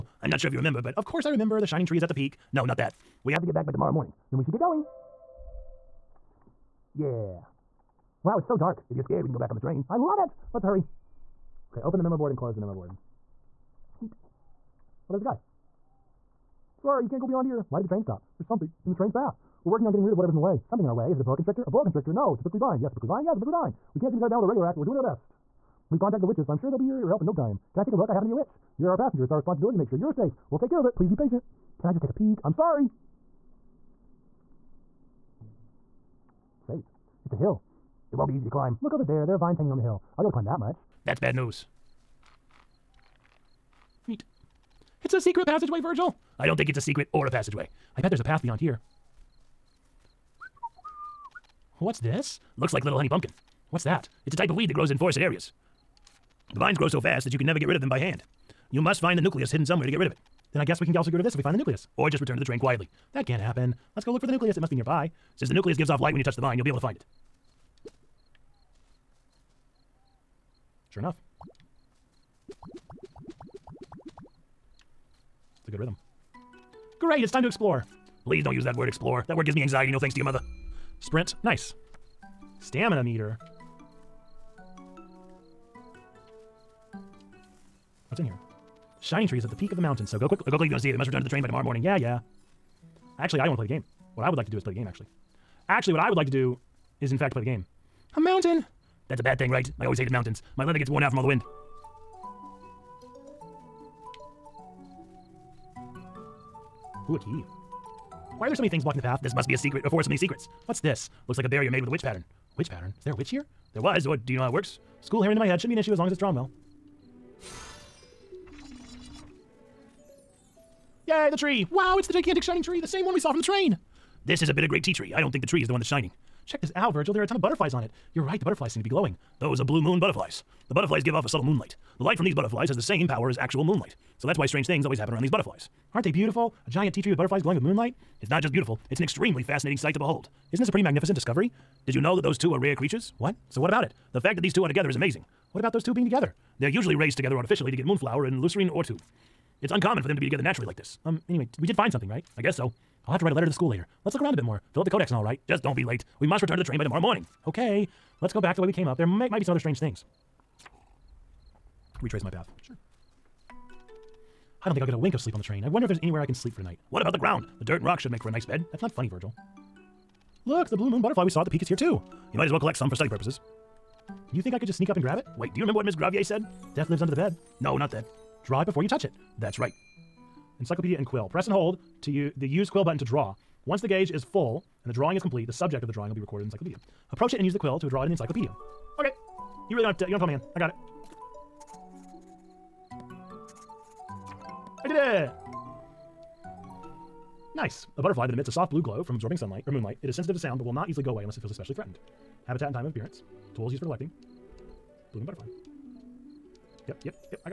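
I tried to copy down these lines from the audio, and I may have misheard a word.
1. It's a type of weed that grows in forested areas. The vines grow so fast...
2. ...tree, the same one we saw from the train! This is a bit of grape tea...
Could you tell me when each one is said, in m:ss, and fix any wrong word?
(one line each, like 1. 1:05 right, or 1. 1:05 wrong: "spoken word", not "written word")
1. 0:54 right
2. 2:02 right.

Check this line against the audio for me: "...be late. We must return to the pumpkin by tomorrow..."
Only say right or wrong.
wrong.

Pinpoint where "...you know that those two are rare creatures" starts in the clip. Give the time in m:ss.
2:21.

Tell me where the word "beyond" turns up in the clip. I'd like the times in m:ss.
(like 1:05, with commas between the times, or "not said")
0:17, 0:48.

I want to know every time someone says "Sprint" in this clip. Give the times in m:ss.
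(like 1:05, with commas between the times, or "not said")
1:21.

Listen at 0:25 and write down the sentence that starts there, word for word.
We've contacted the witches, so I'm sure they'll be here your help in no time.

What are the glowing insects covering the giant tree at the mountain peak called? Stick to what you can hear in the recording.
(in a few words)
Blue moon butterflies.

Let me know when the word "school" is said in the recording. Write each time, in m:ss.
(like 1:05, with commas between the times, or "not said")
1:55, 2:33.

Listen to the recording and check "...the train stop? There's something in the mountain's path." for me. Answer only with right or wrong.
wrong.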